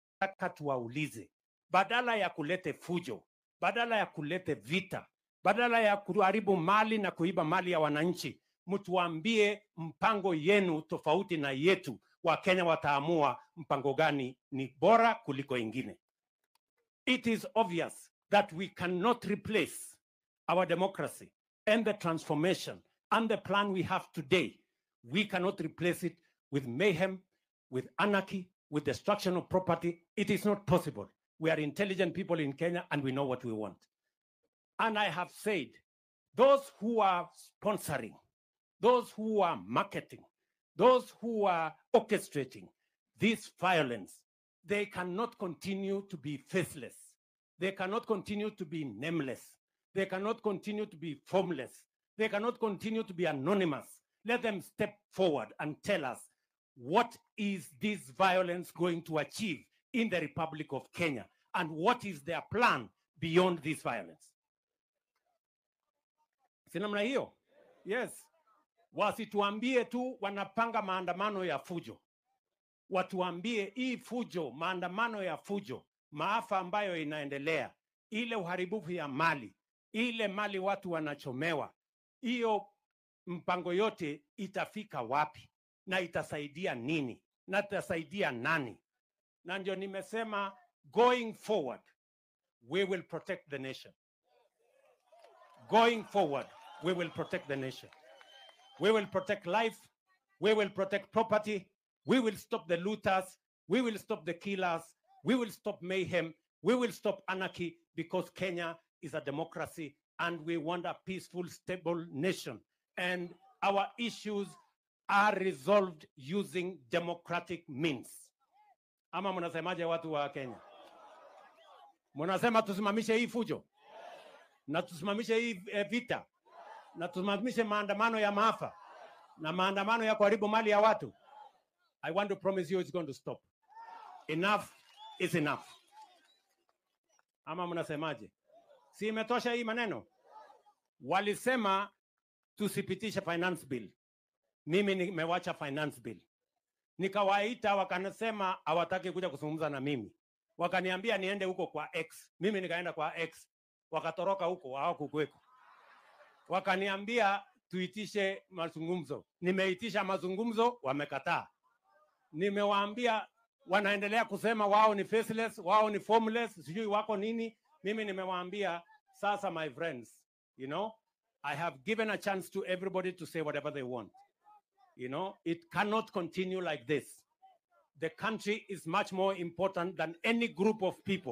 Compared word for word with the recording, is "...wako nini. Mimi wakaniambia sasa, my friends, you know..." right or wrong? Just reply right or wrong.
wrong.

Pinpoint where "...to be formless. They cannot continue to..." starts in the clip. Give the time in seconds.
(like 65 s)
50 s.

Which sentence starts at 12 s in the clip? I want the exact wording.
Wakenya wataamua mpango gani ni bora kuliko ingine.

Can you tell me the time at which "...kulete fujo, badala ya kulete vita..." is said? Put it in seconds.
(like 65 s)
2 s.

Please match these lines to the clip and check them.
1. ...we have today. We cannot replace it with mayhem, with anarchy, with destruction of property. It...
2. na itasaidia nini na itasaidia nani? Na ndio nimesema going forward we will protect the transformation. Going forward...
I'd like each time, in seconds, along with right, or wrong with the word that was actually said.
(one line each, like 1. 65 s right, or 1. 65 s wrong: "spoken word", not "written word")
1. 23 s right
2. 85 s wrong: "nation", not "transformation".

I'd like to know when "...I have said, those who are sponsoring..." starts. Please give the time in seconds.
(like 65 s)
34 s.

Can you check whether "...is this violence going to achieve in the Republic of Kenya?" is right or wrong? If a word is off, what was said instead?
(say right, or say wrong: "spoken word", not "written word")
right.